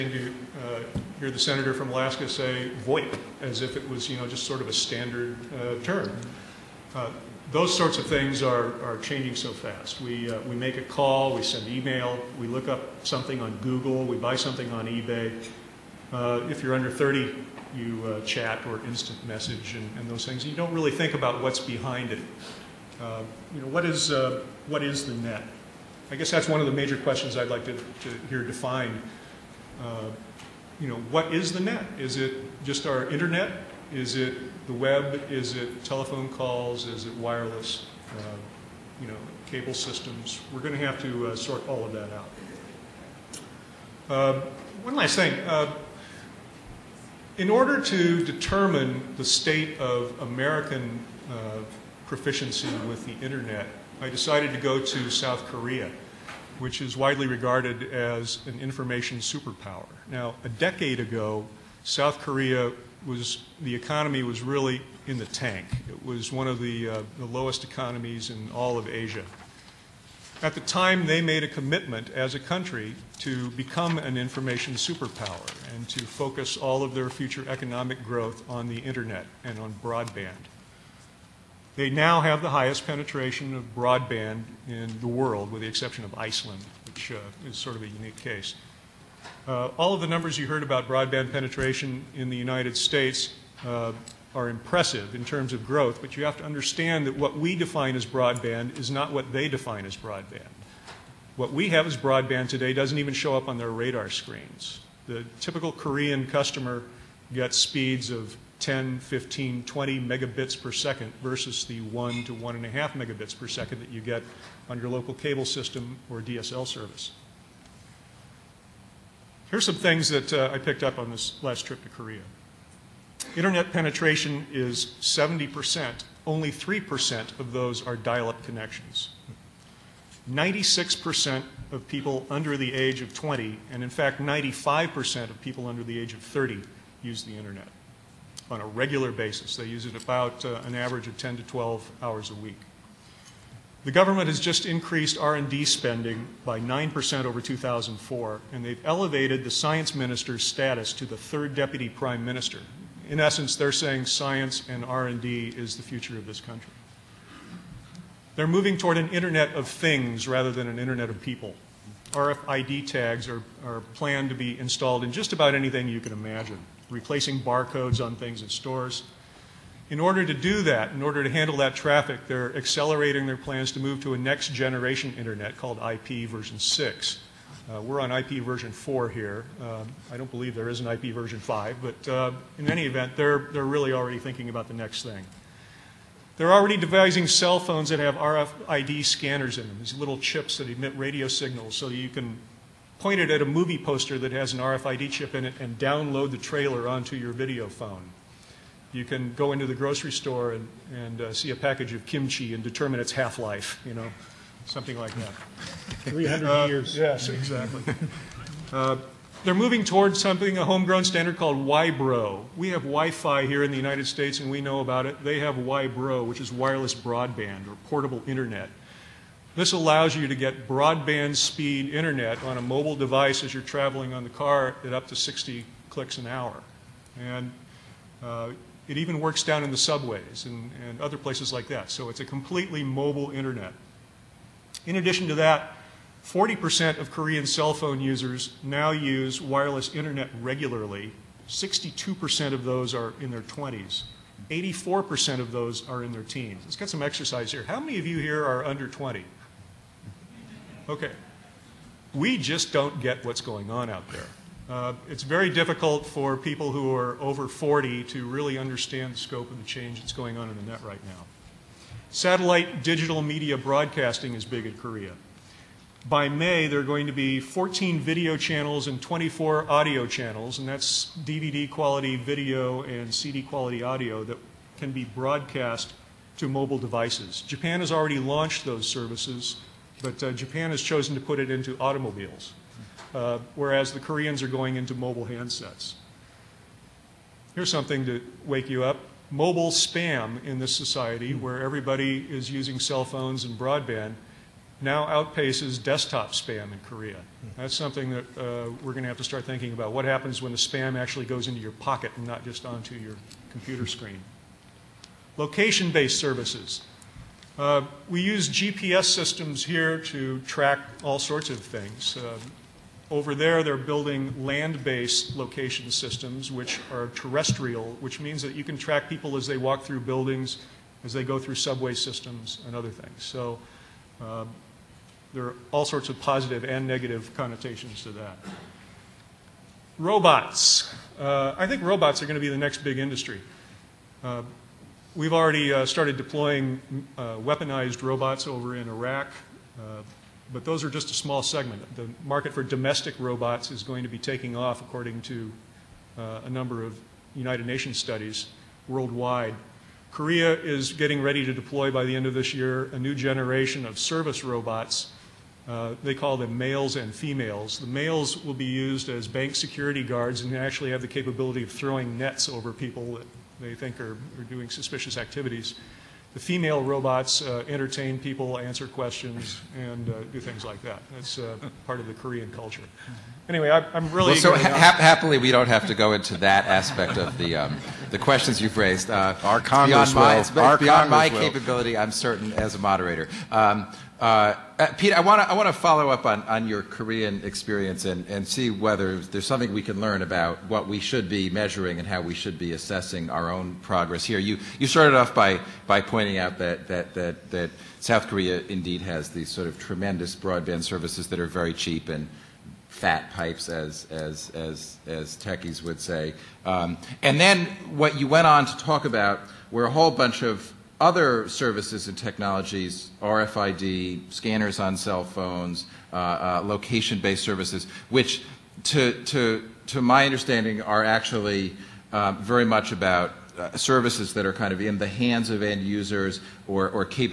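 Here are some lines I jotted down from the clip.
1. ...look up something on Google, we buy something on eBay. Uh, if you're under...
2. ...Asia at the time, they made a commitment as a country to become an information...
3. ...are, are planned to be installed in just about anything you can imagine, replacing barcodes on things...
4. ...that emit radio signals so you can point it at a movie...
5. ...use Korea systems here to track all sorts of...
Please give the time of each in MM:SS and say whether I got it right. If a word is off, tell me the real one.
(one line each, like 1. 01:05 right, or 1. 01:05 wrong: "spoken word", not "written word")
1. 00:12 right
2. 01:08 right
3. 02:43 right
4. 03:10 right
5. 05:08 wrong: "GPS", not "Korea".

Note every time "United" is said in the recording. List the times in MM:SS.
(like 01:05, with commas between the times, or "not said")
01:32, 03:33, 05:47.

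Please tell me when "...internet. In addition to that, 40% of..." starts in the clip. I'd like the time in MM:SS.
03:53.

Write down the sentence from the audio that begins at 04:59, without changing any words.
What happens when the spam actually goes into your pocket and not just onto your computer hmm.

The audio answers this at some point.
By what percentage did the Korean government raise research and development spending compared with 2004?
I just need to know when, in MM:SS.
02:26.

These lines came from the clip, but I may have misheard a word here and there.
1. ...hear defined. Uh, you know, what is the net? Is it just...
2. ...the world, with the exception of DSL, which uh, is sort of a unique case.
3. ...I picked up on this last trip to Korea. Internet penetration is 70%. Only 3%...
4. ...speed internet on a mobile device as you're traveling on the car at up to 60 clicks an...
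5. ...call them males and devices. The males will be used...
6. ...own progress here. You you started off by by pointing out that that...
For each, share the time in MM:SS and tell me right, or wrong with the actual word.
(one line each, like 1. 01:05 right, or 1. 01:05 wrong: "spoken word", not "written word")
1. 00:28 right
2. 01:24 wrong: "Iceland", not "DSL"
3. 02:00 right
4. 03:41 right
5. 05:56 wrong: "females", not "devices"
6. 06:33 right.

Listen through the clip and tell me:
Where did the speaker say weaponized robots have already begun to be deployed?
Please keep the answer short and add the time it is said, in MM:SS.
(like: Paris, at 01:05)
Iraq, at 05:38.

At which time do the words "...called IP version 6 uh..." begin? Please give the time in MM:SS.
02:55.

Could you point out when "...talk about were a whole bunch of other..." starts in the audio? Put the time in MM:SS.
06:48.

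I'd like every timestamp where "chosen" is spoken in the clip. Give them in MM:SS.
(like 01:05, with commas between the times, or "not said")
04:40.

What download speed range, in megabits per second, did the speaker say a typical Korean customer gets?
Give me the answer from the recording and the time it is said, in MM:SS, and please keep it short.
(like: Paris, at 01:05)
10, 15, 20 megabits per second, at 01:48.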